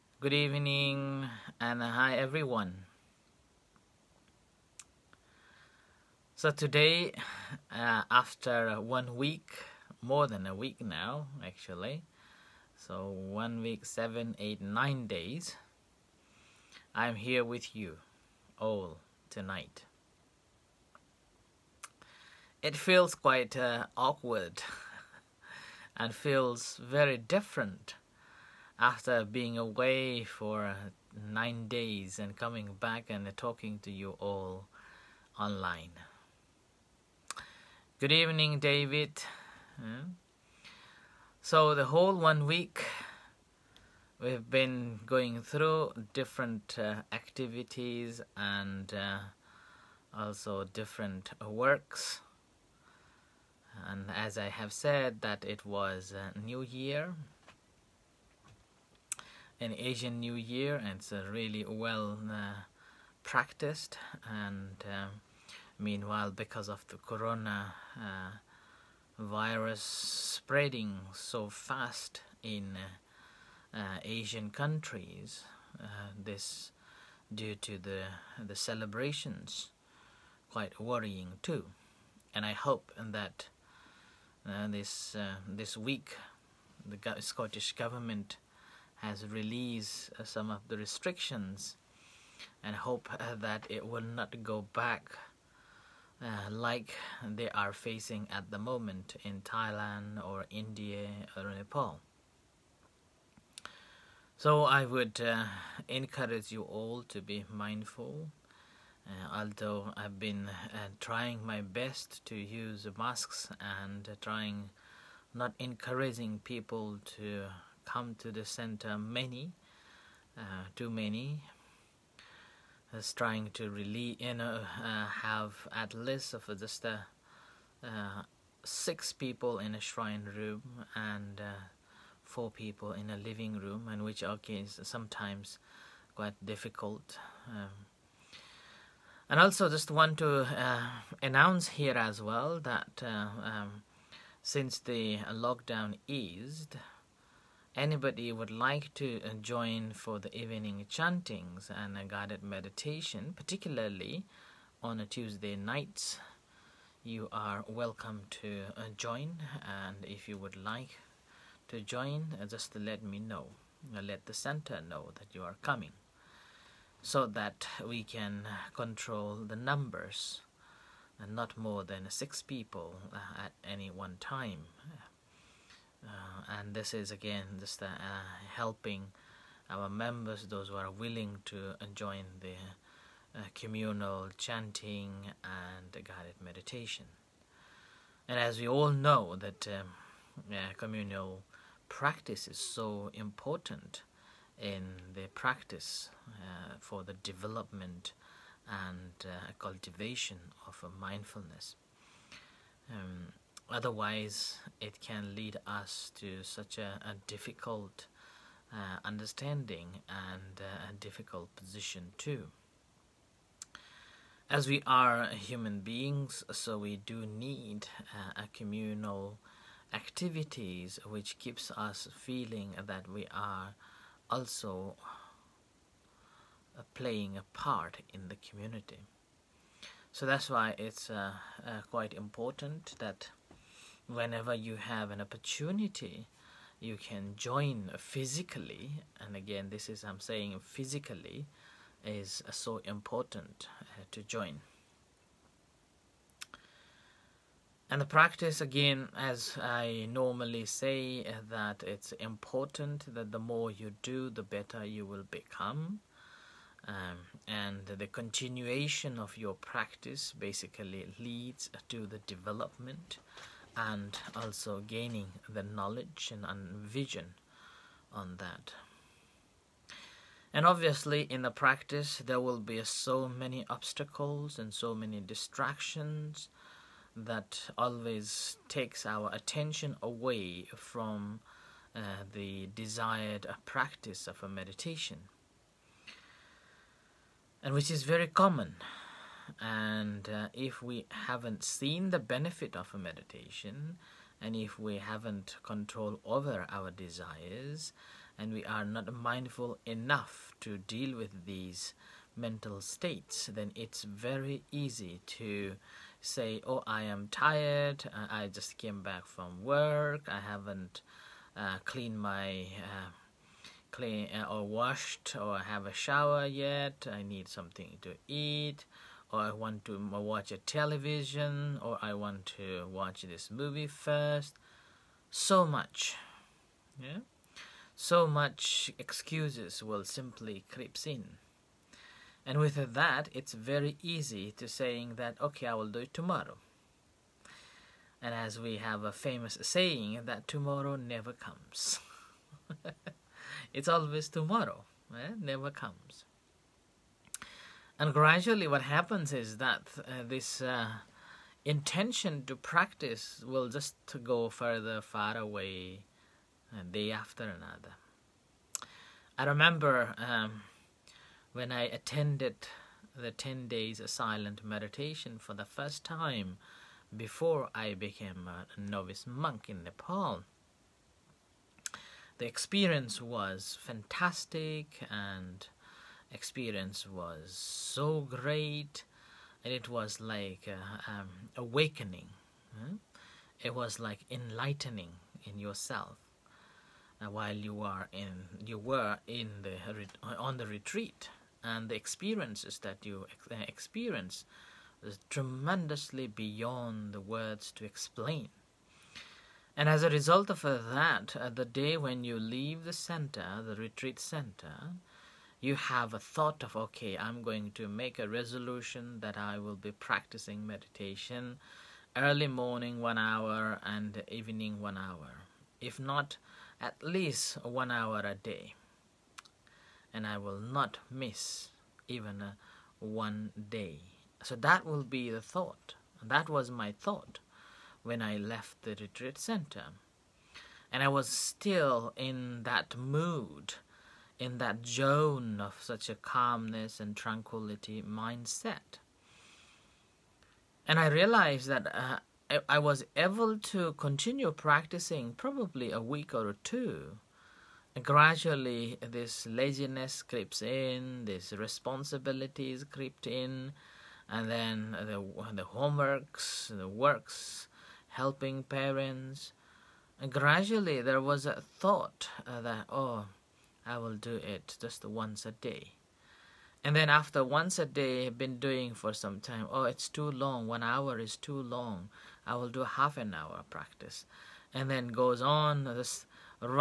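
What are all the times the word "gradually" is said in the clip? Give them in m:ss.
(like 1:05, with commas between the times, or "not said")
5:48, 7:28, 7:40.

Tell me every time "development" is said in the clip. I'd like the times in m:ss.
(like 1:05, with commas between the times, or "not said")
3:17, 4:22.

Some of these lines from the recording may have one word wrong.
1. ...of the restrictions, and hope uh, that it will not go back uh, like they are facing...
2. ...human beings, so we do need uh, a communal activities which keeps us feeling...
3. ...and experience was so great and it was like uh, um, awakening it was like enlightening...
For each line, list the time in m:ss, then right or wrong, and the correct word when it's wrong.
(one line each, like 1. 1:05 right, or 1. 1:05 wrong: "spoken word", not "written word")
1. 1:30 right
2. 3:35 right
3. 6:15 right.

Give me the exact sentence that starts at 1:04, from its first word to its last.
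And uh, meanwhile, because of the corona uh, virus spreading so fast in uh, Asian countries.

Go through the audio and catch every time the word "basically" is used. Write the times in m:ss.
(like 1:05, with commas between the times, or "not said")
4:20.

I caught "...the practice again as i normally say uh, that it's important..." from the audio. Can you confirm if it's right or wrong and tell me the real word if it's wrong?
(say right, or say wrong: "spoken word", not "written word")
right.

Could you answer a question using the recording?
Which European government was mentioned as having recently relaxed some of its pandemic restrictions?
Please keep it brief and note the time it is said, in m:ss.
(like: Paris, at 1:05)
Scottish government, at 1:27.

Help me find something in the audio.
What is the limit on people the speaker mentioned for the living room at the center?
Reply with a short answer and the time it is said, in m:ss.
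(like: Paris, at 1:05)
4, at 2:12.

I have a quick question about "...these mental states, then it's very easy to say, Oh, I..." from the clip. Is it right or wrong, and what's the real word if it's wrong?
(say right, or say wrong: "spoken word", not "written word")
right.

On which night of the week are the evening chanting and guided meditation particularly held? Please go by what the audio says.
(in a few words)
Tuesday.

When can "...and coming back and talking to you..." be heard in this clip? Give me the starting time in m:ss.
0:32.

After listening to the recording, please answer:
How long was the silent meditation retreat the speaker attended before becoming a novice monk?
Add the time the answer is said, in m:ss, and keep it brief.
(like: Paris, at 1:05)
10 days, at 6:03.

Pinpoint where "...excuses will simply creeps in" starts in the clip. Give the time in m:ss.
5:28.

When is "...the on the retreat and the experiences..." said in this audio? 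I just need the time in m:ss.
6:29.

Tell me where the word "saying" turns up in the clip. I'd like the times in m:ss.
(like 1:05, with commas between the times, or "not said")
4:00, 5:34, 5:39.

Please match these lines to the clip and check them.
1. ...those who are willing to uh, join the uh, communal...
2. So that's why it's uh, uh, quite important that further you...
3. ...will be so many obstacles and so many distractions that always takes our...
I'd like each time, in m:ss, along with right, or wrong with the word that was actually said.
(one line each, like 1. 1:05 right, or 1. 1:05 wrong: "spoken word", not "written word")
1. 3:00 right
2. 3:50 wrong: "whenever", not "further"
3. 4:32 right.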